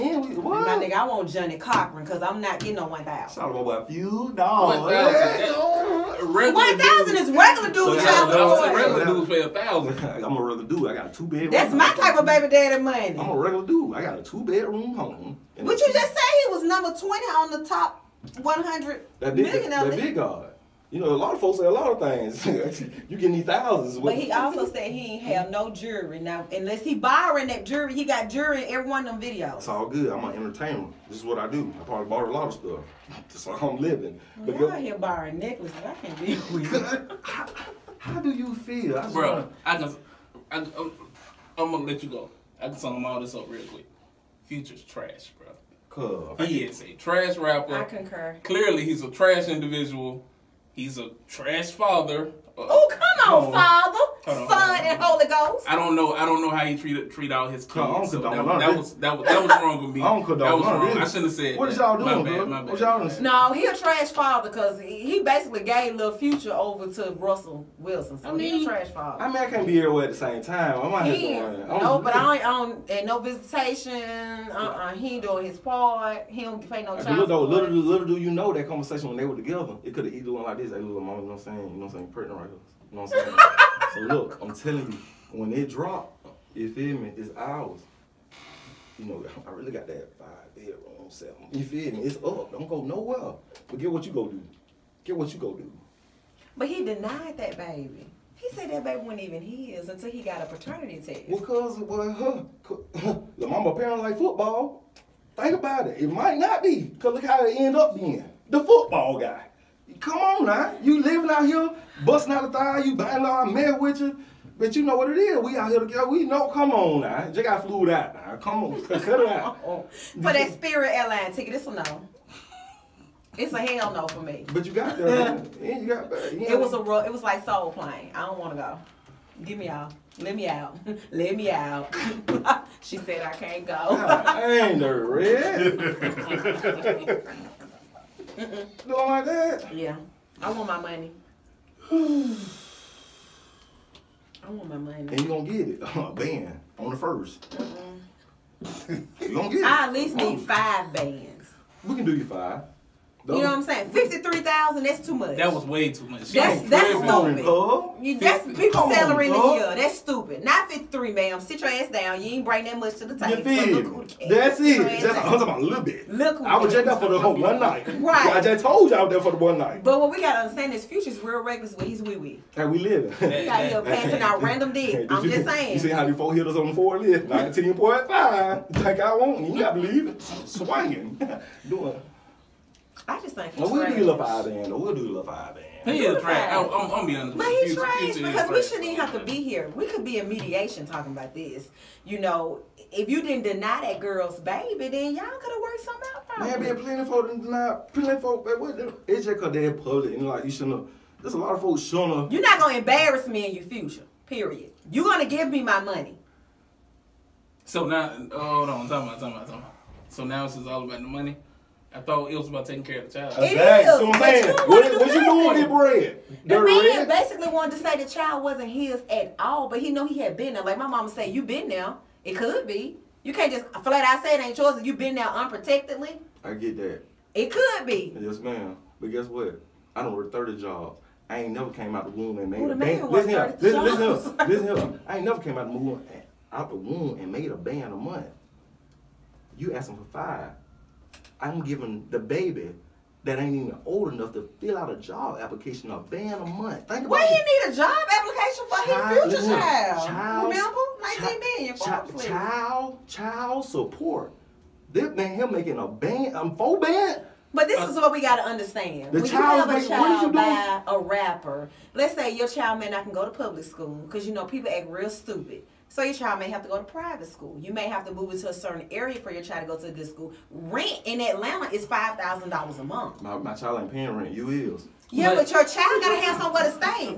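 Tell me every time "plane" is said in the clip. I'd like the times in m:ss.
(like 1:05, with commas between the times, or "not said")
2:07.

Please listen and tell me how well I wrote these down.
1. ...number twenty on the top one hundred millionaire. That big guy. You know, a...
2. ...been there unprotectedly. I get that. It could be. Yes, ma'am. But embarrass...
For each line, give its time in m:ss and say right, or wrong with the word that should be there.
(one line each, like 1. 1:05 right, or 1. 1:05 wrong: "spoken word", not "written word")
1. 0:16 right
2. 3:44 wrong: "guess", not "embarrass".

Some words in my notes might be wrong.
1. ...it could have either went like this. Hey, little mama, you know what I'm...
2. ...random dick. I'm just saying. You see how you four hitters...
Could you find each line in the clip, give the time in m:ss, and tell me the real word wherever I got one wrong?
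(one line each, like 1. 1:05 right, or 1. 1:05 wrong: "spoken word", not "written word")
1. 1:19 right
2. 2:54 right.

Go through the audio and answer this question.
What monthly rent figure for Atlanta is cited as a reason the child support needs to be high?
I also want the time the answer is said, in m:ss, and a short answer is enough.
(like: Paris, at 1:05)
$5,000, at 4:31.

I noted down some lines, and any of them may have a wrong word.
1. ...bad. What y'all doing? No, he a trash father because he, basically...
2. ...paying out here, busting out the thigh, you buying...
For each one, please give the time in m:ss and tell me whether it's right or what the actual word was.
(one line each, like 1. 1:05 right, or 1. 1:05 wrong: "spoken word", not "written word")
1. 1:02 right
2. 1:51 wrong: "living", not "paying".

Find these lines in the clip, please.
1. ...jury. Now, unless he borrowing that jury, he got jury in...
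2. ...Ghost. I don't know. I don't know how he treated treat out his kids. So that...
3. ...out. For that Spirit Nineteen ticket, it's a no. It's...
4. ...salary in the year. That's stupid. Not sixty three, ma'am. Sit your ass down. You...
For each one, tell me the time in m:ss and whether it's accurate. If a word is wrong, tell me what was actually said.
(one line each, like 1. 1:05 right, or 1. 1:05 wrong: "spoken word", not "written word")
1. 0:25 right
2. 0:55 right
3. 1:59 wrong: "Airline", not "Nineteen"
4. 2:38 wrong: "fifty", not "sixty".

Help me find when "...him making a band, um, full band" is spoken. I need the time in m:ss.
4:15.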